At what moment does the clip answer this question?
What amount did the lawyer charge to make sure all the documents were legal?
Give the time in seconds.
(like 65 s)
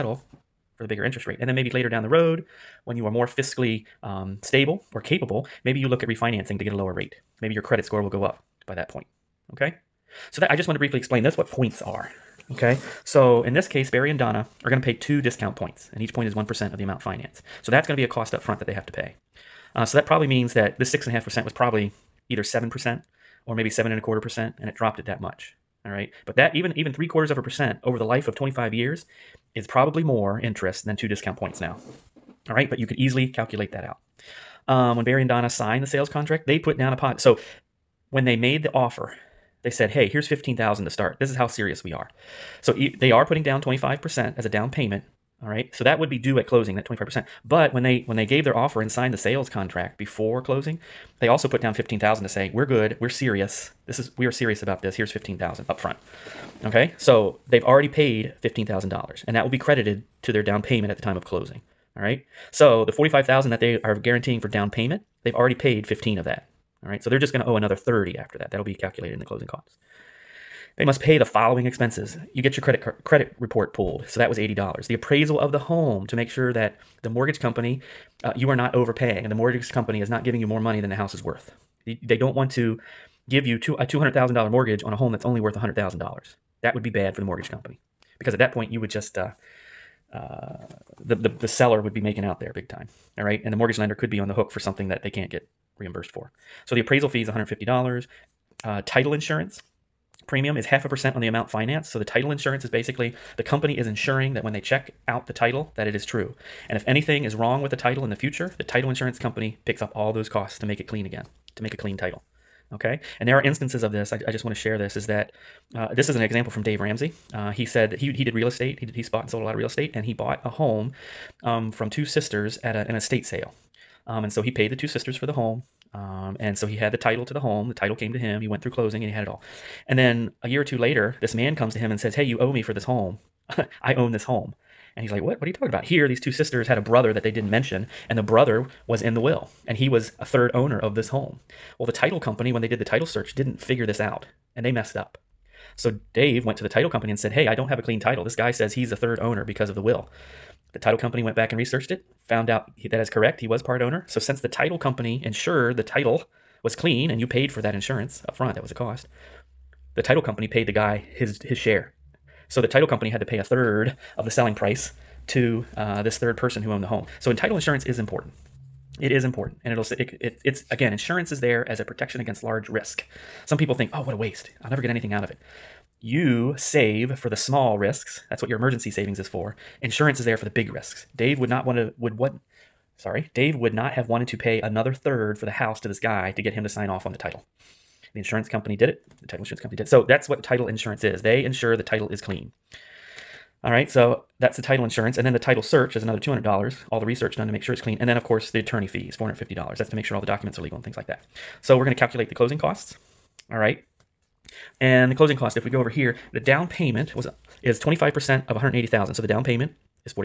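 199 s.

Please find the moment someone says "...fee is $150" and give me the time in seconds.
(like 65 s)
97 s.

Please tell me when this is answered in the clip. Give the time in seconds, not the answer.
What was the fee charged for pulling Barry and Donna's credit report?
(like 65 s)
74 s.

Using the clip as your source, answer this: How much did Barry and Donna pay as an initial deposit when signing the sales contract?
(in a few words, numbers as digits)
$15,000.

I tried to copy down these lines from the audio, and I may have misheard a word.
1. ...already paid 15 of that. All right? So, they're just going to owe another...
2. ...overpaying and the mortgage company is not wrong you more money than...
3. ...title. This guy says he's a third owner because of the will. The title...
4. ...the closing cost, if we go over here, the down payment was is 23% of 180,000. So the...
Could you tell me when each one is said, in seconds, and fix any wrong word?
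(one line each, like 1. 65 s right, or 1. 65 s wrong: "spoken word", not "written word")
1. 65 s right
2. 78 s wrong: "giving", not "wrong"
3. 148 s right
4. 205 s wrong: "25", not "23".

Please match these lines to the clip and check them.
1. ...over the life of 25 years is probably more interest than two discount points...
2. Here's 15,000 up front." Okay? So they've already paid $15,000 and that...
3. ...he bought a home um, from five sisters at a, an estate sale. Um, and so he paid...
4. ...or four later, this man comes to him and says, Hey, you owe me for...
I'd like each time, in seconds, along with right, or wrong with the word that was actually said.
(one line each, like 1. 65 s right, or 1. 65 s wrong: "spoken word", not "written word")
1. 27 s right
2. 54 s right
3. 120 s wrong: "two", not "five"
4. 130 s wrong: "two", not "four".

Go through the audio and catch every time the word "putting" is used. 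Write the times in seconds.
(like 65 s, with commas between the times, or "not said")
43 s.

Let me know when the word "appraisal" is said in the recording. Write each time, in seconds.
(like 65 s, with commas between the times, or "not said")
74 s, 96 s.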